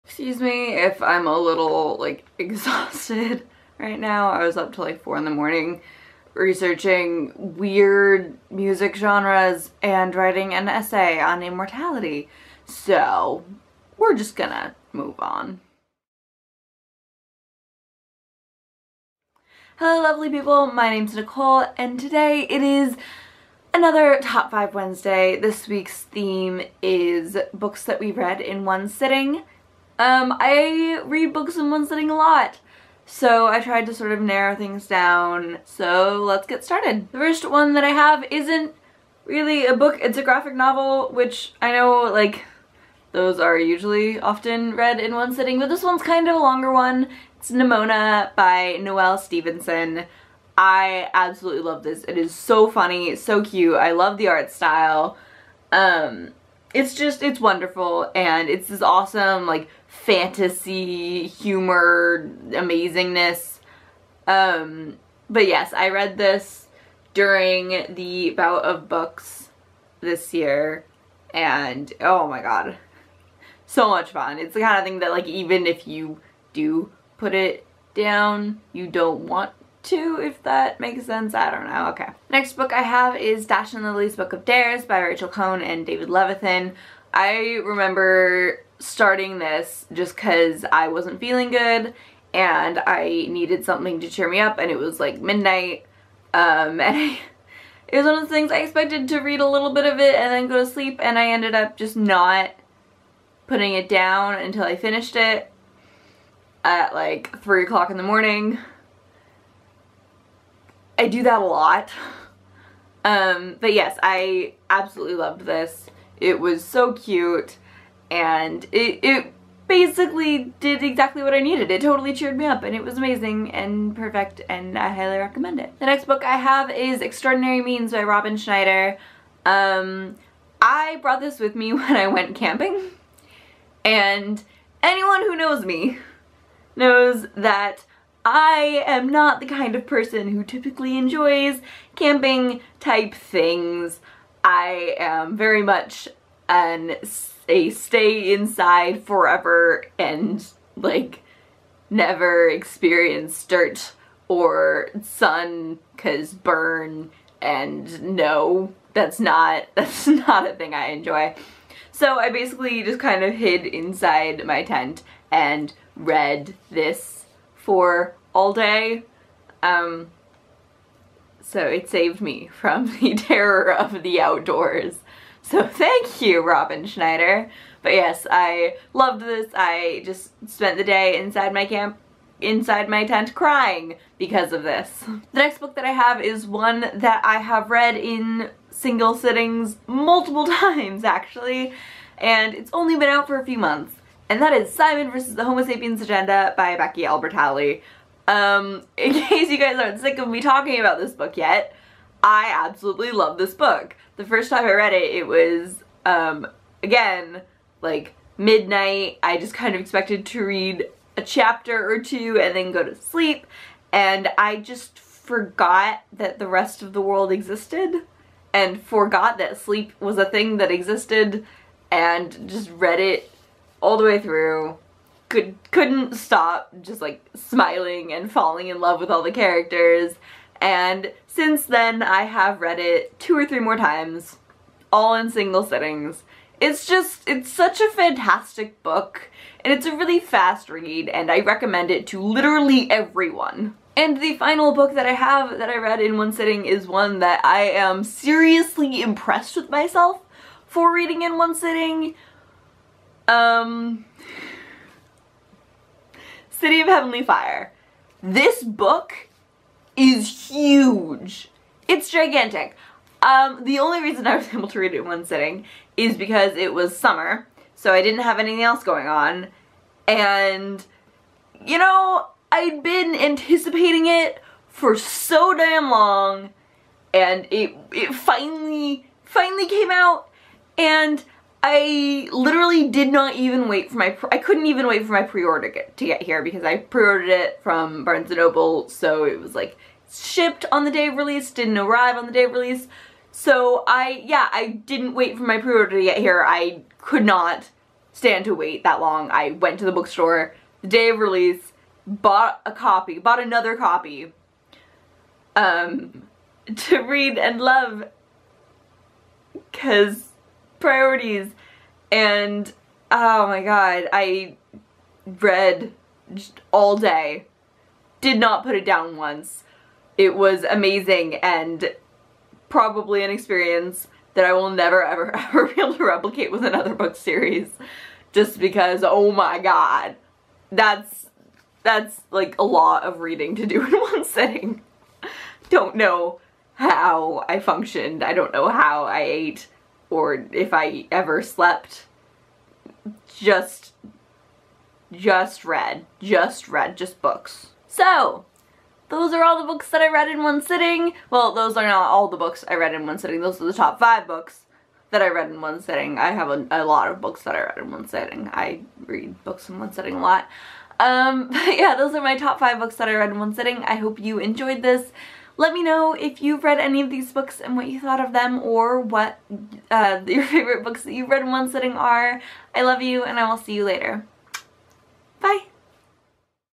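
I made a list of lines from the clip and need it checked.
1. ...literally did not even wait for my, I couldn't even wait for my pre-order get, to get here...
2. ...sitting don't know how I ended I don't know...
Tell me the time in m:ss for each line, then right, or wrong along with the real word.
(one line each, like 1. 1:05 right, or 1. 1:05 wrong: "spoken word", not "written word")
1. 4:42 right
2. 5:34 wrong: "functioned", not "ended".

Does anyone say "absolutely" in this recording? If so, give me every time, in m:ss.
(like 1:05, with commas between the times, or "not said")
0:51, 1:54, 3:22.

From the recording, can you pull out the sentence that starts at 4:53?
So I, yeah, I didn't wait for my pre-order to get here.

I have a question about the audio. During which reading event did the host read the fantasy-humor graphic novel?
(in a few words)
bout of books.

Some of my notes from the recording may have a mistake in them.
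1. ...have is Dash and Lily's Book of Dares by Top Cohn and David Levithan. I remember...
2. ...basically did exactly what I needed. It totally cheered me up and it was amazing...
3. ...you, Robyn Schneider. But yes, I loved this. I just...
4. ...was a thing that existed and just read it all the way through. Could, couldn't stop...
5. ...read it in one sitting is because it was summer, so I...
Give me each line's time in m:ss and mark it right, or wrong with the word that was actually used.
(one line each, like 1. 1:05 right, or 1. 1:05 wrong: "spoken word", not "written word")
1. 1:22 wrong: "Rachel", not "Top"
2. 1:59 right
3. 2:56 right
4. 3:39 right
5. 4:24 right.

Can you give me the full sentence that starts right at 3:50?
And since then, I have read it two or three more times, all in single sittings.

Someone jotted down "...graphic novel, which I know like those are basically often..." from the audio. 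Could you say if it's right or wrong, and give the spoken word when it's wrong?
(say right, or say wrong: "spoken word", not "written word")
wrong: "usually", not "basically".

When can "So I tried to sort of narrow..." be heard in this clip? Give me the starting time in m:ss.
0:33.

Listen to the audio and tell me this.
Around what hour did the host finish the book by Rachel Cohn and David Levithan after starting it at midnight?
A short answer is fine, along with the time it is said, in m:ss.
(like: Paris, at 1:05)
3 o'clock, at 1:47.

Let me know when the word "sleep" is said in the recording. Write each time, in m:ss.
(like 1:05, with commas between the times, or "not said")
1:40, 3:32, 3:39.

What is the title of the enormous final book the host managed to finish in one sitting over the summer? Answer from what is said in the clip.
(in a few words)
City of Heavenly Fire.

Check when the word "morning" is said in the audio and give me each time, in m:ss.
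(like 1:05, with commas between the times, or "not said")
0:05, 1:48.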